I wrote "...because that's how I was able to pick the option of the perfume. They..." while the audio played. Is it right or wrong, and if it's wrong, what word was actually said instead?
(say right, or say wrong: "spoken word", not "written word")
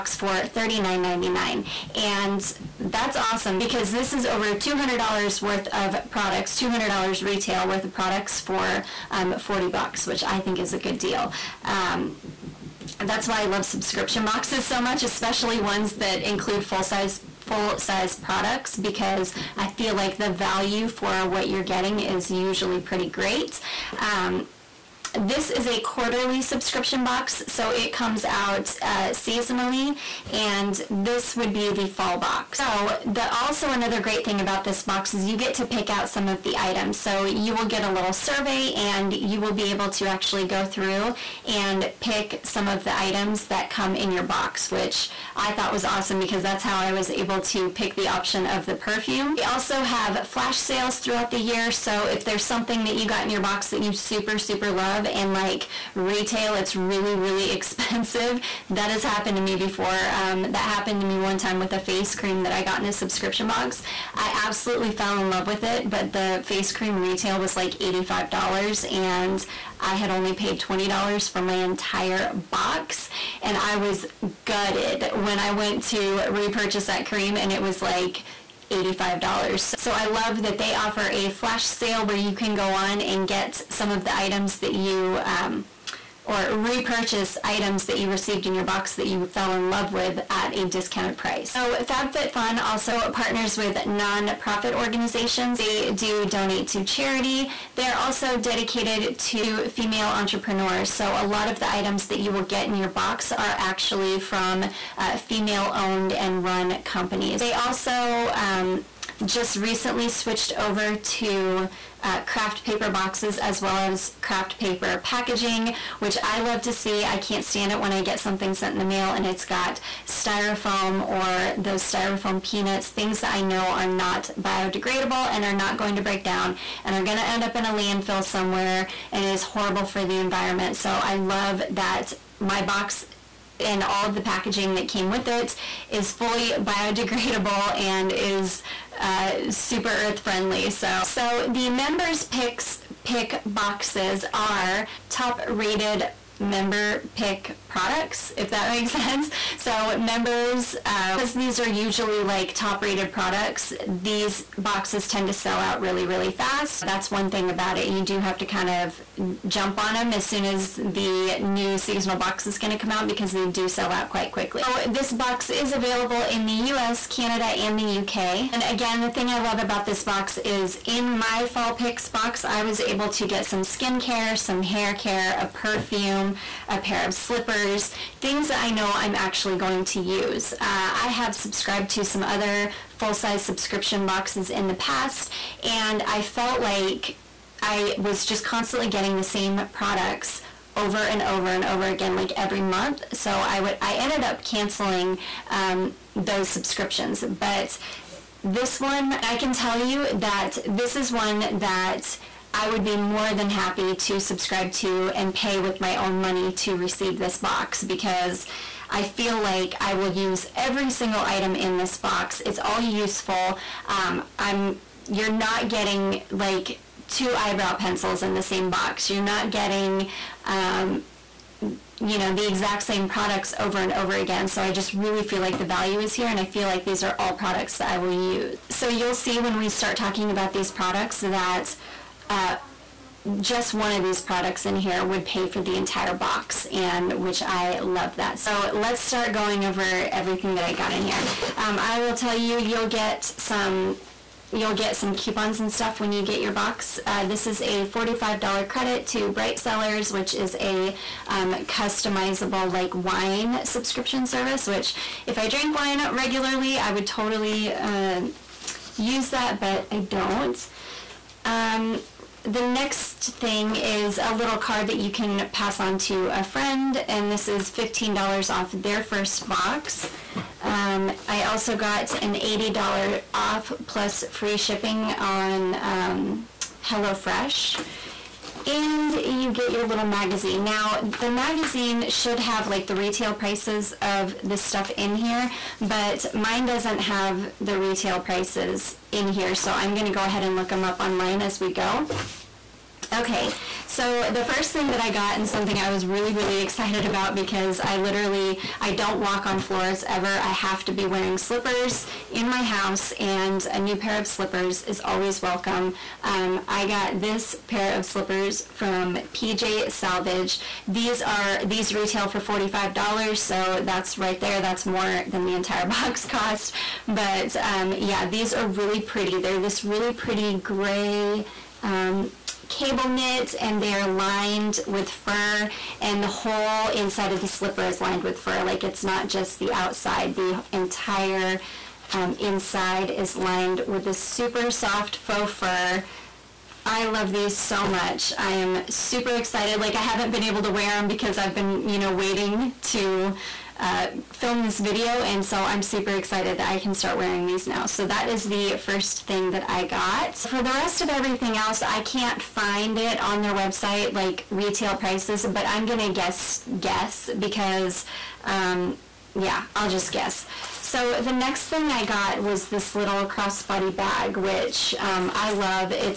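right.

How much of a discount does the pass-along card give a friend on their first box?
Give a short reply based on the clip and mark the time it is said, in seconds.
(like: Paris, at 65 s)
$15 off, at 267 s.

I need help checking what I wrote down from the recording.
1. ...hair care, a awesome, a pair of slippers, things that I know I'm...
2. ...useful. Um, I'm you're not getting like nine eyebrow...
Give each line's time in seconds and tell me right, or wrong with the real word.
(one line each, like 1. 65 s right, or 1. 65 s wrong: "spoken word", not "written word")
1. 174 s wrong: "perfume", not "awesome"
2. 212 s wrong: "two", not "nine".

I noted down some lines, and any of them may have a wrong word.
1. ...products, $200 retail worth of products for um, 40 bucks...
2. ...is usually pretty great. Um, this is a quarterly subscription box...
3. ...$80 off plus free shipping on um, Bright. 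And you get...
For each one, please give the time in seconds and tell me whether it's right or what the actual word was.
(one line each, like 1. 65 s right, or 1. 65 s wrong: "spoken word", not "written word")
1. 6 s right
2. 22 s right
3. 272 s wrong: "HelloFresh", not "Bright".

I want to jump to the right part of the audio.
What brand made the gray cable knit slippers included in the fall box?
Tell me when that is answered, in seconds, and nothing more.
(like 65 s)
309 s.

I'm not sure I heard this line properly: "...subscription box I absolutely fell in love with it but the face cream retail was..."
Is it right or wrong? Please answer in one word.
right.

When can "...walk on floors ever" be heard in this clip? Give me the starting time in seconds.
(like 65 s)
299 s.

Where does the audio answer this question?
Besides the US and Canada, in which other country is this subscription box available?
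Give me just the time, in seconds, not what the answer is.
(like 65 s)
168 s.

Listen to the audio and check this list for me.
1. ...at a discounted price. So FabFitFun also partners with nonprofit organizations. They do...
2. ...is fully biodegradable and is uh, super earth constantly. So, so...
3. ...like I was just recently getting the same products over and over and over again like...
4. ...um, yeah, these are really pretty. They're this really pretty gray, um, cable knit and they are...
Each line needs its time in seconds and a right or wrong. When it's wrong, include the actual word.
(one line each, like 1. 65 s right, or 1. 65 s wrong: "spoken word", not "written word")
1. 90 s right
2. 135 s wrong: "friendly", not "constantly"
3. 186 s wrong: "constantly", not "recently"
4. 317 s right.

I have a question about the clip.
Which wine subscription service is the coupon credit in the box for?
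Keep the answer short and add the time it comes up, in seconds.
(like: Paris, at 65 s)
Bright Cellars, at 249 s.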